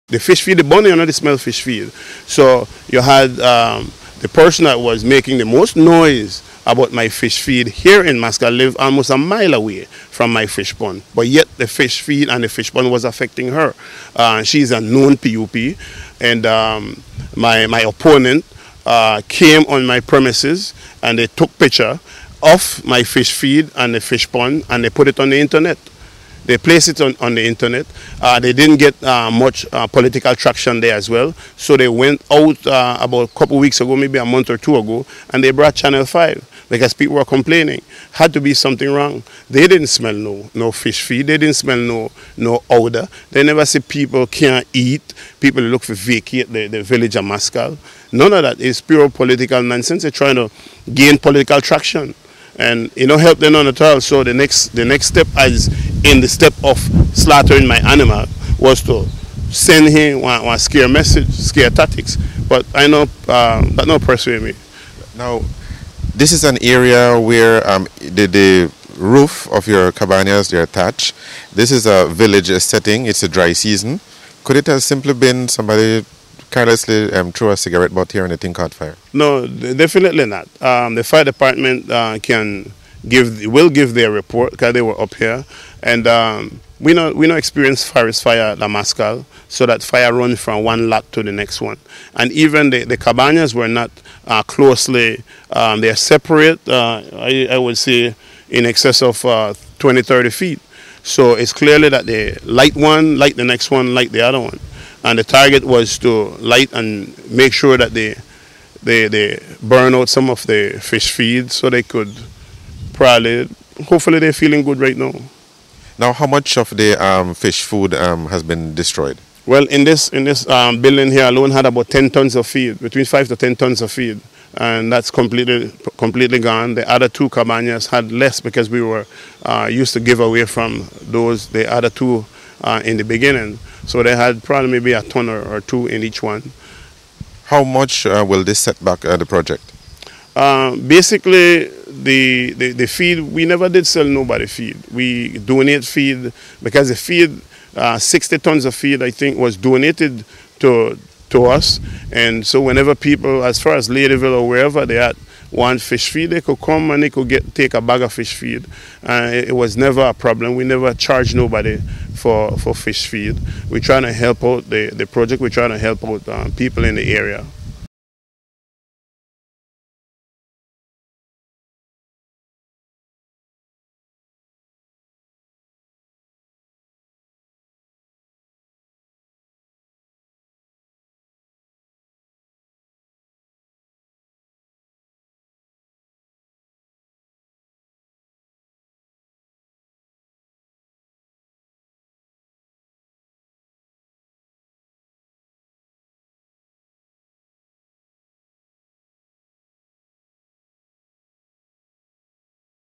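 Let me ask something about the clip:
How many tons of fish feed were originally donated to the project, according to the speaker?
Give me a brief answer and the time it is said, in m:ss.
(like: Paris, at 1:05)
60 tons, at 2:27.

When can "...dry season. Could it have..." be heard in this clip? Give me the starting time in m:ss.
1:13.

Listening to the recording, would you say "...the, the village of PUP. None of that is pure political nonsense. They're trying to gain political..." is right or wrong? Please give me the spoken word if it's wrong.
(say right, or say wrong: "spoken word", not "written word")
wrong: "Maskall", not "PUP".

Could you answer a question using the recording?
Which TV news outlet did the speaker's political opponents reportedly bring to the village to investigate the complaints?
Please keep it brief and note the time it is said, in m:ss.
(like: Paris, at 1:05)
Channel 5, at 0:35.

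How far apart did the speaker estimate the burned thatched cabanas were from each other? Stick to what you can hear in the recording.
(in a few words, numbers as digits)
20 30 feet.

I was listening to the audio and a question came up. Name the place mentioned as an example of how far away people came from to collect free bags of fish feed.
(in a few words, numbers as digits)
Ladyville.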